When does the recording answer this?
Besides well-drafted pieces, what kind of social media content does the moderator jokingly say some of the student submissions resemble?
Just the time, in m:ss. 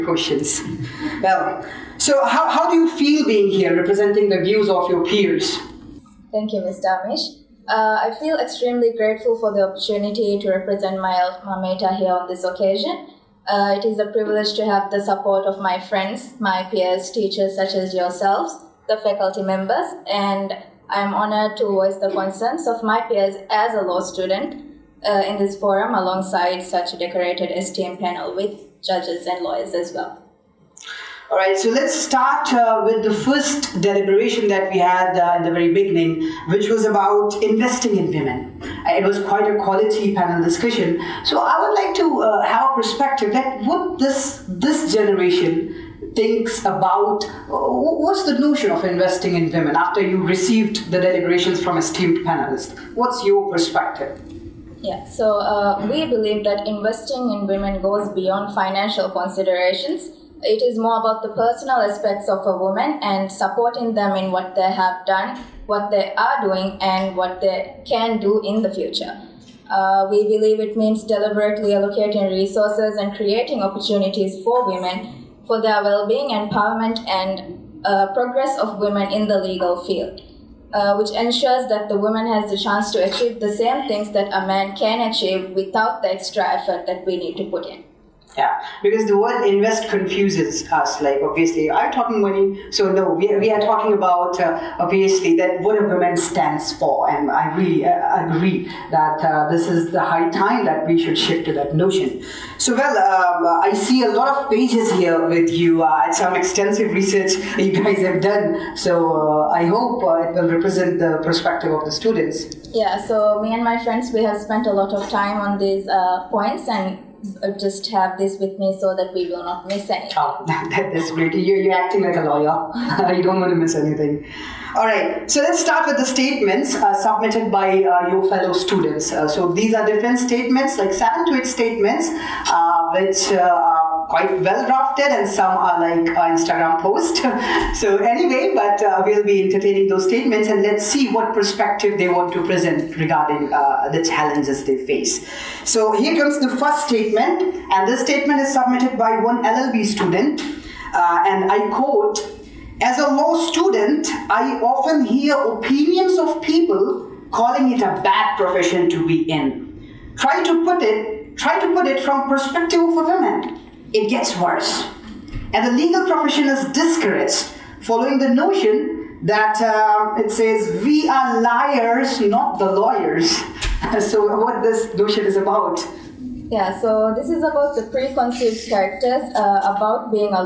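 2:16.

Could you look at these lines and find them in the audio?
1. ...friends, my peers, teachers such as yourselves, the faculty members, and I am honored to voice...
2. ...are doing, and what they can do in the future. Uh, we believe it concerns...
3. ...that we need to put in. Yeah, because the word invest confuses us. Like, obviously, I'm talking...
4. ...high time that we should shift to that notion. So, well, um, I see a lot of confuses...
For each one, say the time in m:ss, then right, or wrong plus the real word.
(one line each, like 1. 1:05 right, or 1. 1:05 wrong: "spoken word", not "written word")
1. 0:15 right
2. 1:06 wrong: "means", not "concerns"
3. 1:26 right
4. 1:40 wrong: "pages", not "confuses".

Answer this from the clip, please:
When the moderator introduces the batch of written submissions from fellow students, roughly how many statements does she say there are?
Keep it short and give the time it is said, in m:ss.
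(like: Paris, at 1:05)
7 to 8, at 2:10.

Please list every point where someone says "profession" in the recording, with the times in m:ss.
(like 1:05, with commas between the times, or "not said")
2:38, 2:46.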